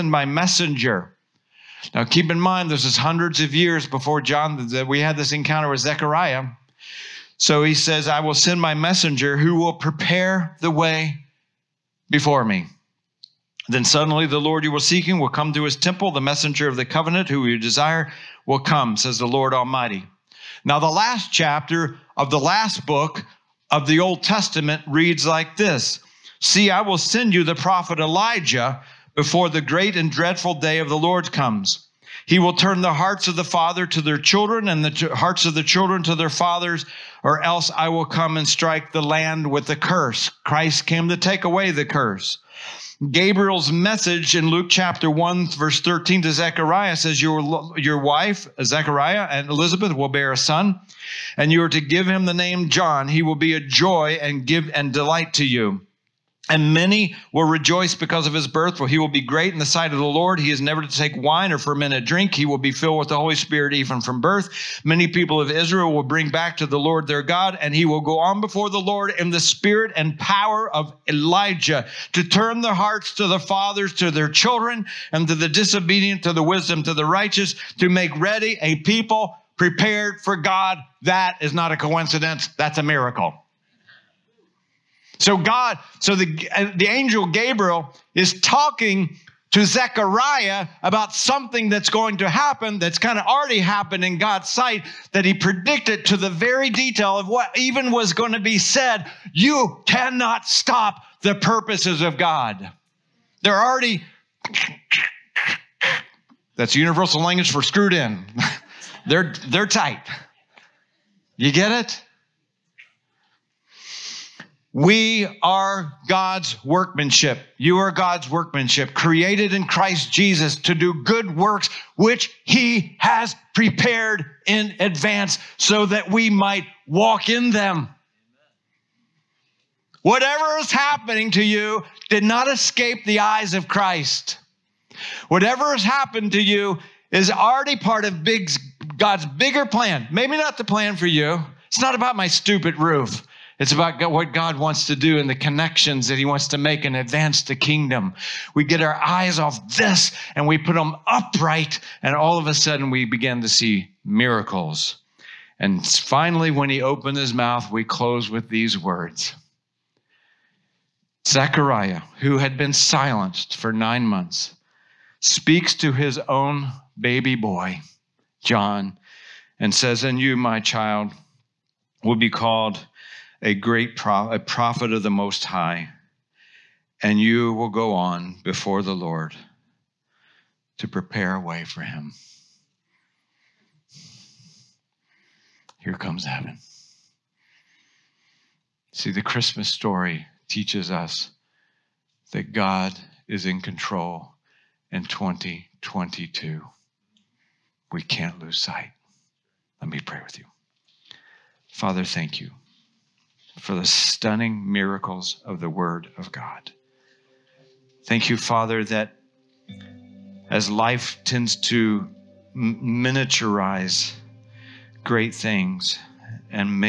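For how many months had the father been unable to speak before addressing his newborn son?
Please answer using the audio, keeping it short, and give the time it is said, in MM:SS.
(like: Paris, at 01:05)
9, at 02:43.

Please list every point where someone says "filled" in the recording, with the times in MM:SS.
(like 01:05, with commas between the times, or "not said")
01:02.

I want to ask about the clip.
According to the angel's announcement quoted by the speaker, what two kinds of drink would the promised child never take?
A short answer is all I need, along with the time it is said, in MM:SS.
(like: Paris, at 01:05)
wine or fermented drink, at 01:01.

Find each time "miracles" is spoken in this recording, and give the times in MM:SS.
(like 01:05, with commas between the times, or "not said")
01:22, 02:34, 03:24.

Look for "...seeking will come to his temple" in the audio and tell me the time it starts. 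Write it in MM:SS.
00:14.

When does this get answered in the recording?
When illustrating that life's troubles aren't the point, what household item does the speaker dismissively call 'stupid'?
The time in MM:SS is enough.
02:22.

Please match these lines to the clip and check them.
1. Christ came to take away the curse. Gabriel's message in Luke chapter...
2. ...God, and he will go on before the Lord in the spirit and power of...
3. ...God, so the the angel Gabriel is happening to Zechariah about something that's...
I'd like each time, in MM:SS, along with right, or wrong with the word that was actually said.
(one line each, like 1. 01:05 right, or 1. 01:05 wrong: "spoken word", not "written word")
1. 00:40 right
2. 01:07 right
3. 01:25 wrong: "talking", not "happening".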